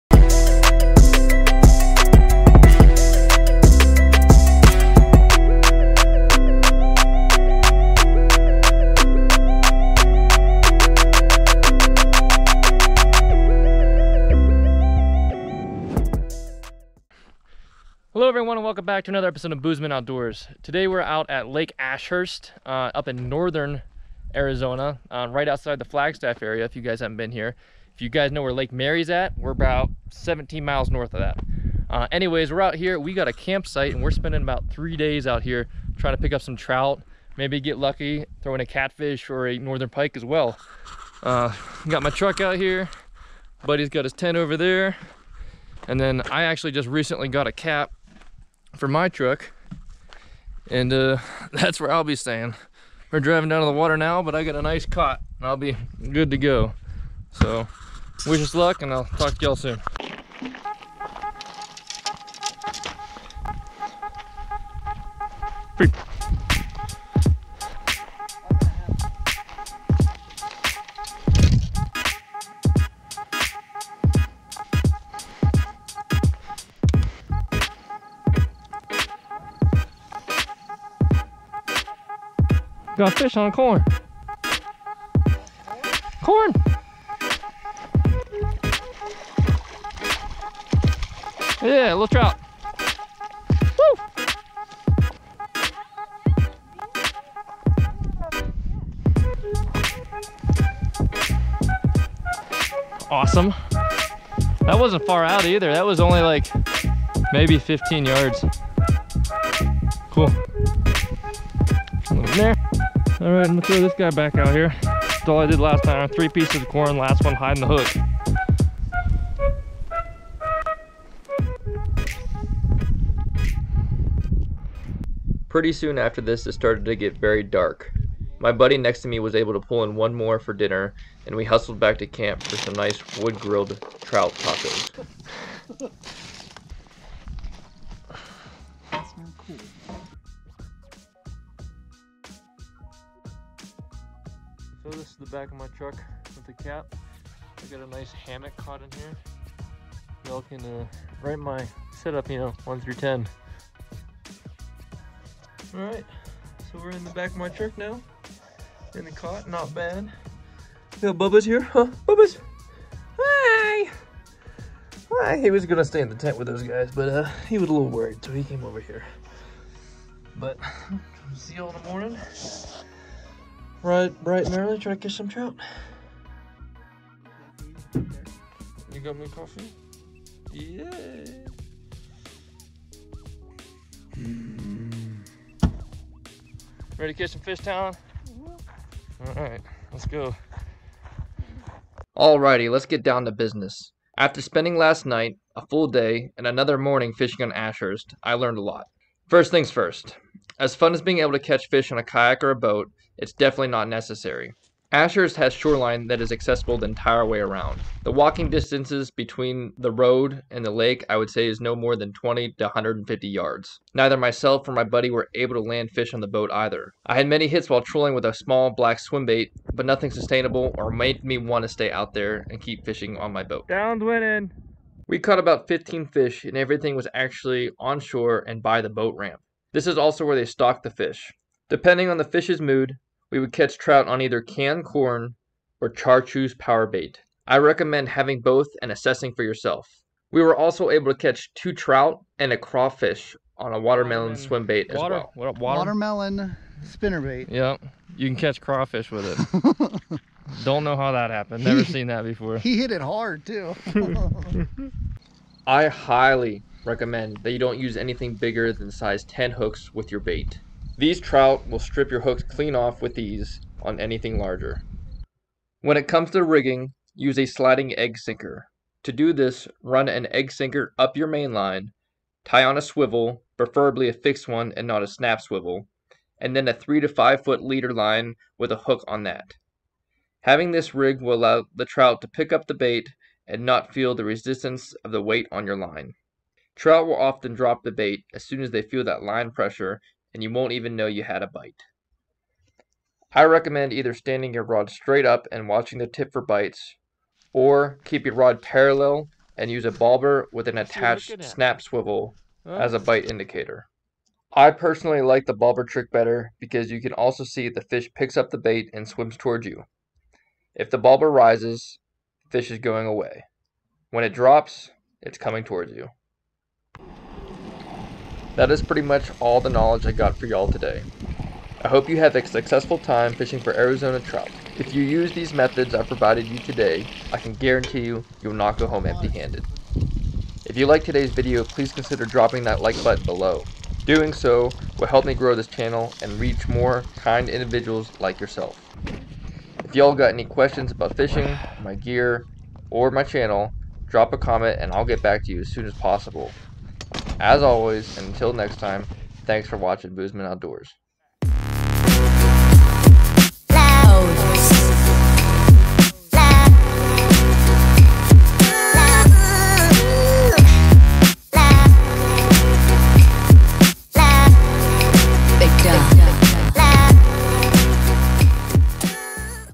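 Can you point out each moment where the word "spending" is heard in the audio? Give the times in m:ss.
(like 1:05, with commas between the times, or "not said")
0:34, 3:14.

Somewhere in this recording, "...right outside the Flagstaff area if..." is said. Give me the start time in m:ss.
0:25.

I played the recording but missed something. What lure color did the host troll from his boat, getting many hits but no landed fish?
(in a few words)
Black.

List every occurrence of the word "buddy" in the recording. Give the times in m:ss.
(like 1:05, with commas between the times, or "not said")
0:43, 2:08, 3:34.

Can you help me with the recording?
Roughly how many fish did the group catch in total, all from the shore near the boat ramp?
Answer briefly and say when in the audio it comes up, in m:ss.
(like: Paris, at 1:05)
15, at 3:45.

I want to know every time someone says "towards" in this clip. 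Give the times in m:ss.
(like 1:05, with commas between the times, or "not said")
5:09, 5:15.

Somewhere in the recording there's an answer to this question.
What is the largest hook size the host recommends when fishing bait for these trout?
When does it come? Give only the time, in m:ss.
4:18.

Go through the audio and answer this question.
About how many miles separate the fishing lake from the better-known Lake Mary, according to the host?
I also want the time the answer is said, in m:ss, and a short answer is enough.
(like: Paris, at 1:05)
17 miles, at 0:30.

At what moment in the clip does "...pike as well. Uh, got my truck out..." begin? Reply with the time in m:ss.
0:39.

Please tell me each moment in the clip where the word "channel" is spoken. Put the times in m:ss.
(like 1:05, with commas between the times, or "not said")
5:35, 5:43.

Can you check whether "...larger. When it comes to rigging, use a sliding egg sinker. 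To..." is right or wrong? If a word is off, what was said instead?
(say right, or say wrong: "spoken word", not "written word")
right.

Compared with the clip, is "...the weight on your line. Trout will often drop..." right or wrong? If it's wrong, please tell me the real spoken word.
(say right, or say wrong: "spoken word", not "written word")
right.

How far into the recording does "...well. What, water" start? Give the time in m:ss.
4:05.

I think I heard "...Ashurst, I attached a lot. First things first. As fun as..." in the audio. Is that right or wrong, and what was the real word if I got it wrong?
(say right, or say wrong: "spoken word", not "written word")
wrong: "learned", not "attached".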